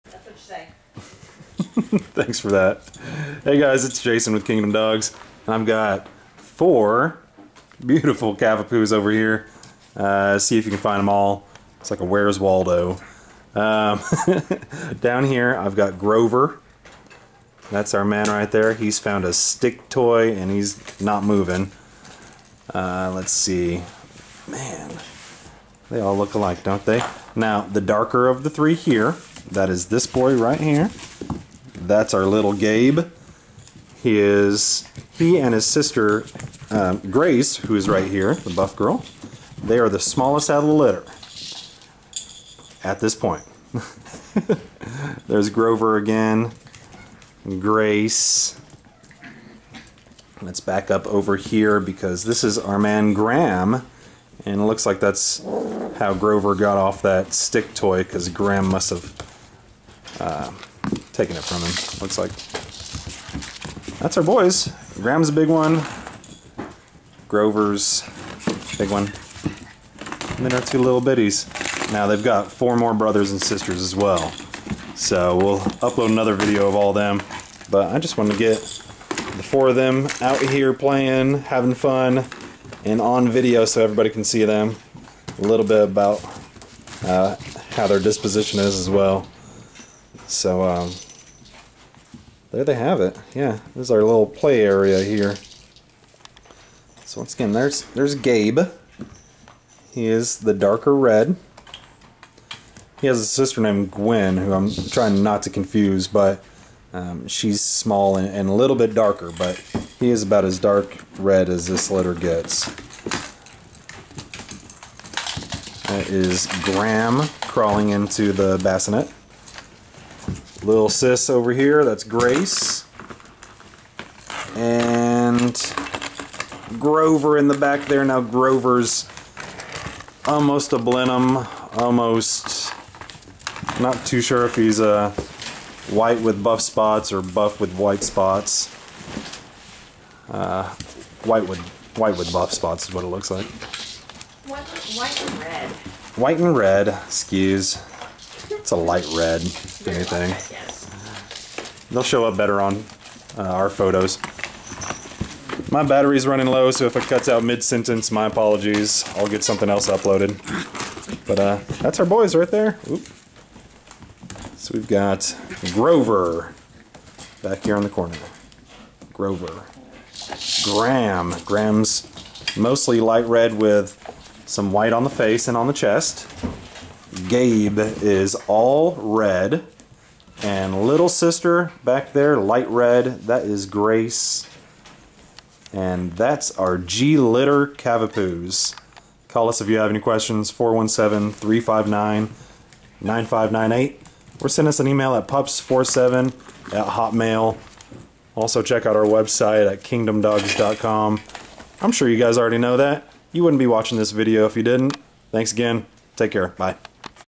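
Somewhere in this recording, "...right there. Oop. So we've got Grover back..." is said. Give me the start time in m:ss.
2:42.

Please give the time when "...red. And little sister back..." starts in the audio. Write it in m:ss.
2:58.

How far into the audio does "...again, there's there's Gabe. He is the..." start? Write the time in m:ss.
1:37.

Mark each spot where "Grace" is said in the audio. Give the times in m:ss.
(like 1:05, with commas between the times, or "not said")
0:37, 0:47, 2:02, 3:03.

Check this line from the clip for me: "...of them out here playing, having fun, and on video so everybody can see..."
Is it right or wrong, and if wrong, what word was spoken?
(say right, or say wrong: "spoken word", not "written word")
right.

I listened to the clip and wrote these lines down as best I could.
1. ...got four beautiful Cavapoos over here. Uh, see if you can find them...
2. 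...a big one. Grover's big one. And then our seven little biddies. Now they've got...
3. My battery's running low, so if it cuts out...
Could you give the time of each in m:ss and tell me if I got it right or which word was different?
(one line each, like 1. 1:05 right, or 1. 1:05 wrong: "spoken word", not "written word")
1. 0:05 right
2. 1:05 wrong: "two", not "seven"
3. 2:35 right.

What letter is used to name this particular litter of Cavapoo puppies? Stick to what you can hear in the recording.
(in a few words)
G.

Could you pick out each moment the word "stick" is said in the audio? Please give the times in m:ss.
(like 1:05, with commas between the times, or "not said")
0:19, 0:57.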